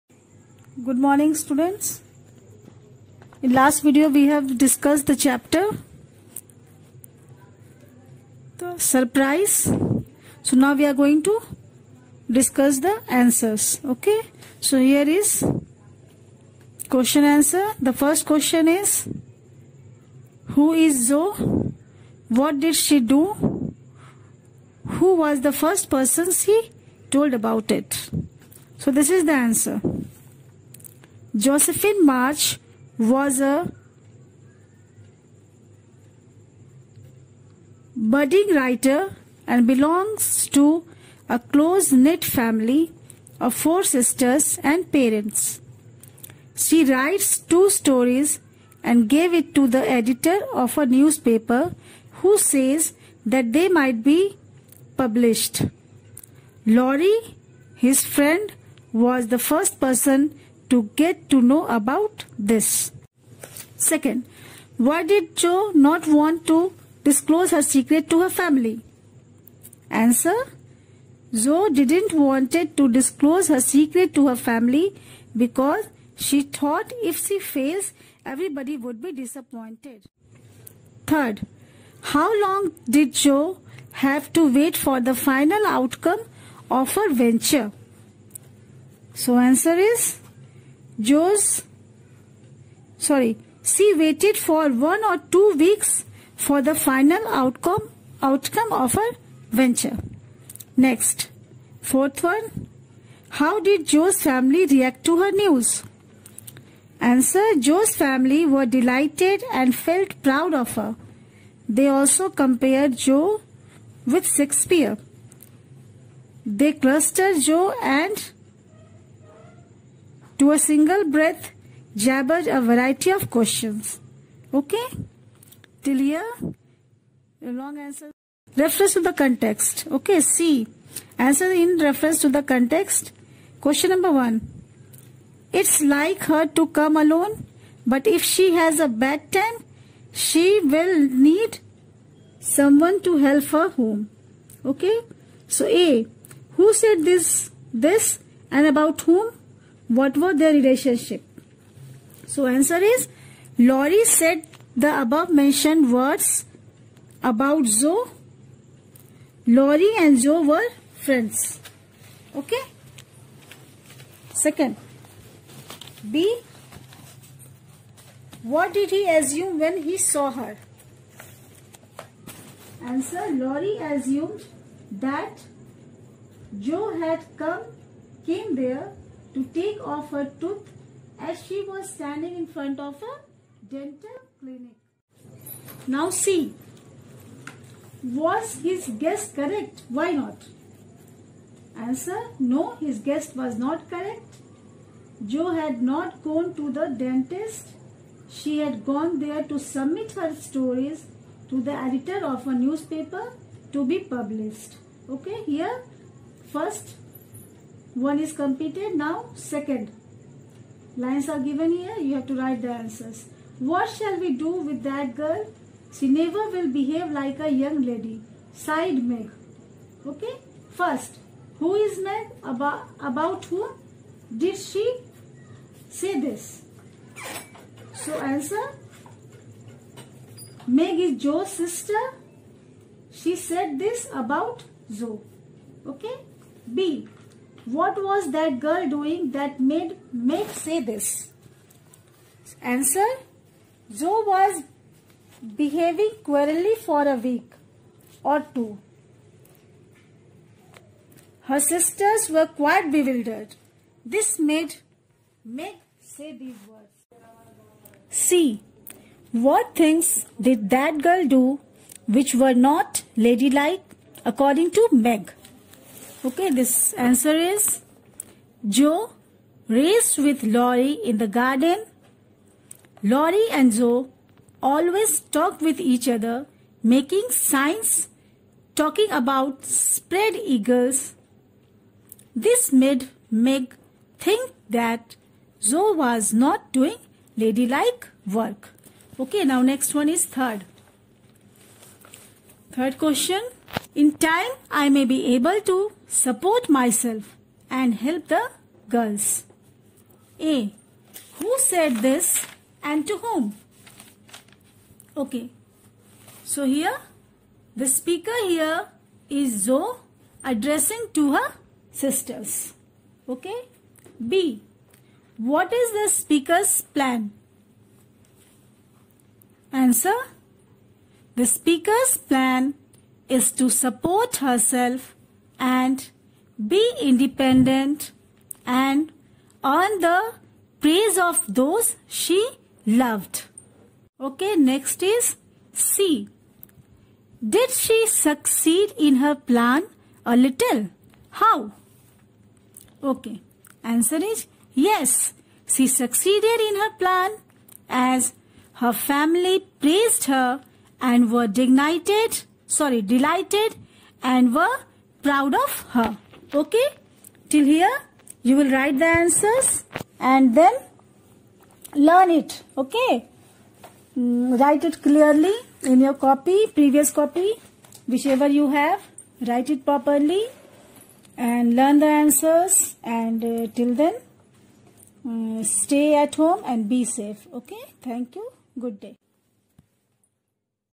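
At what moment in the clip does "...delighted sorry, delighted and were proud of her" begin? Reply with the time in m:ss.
5:51.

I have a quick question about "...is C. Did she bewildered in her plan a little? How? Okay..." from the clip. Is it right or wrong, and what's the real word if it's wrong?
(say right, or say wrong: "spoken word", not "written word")
wrong: "succeed", not "bewildered".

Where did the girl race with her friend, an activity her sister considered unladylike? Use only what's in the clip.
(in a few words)
in the garden.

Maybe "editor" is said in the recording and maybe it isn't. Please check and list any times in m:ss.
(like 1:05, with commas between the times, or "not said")
0:49, 3:21.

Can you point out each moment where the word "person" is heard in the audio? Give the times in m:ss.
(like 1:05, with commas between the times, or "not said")
0:25, 0:59.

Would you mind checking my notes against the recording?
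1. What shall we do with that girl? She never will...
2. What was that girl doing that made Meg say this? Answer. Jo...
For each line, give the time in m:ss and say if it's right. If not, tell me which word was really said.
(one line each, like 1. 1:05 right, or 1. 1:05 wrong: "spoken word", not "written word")
1. 3:33 right
2. 3:57 right.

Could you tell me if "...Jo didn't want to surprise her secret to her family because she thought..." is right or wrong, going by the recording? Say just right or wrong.
wrong.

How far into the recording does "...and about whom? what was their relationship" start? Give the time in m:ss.
2:28.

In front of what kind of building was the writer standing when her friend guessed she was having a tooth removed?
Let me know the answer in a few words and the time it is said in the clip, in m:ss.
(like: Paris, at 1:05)
a dental clinic, at 3:03.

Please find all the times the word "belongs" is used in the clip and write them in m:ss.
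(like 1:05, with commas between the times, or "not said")
0:39.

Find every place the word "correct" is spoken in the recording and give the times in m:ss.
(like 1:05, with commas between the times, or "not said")
3:09, 3:13.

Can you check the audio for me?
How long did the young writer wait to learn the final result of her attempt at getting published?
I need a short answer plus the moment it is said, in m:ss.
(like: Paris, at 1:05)
one or two weeks, at 1:34.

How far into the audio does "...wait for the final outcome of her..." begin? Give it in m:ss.
1:24.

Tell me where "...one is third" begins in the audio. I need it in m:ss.
4:49.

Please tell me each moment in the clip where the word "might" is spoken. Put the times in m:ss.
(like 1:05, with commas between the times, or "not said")
0:53.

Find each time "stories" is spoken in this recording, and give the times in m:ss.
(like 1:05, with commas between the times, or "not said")
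0:47, 3:20.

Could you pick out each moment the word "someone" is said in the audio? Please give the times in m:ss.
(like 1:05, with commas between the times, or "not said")
2:22.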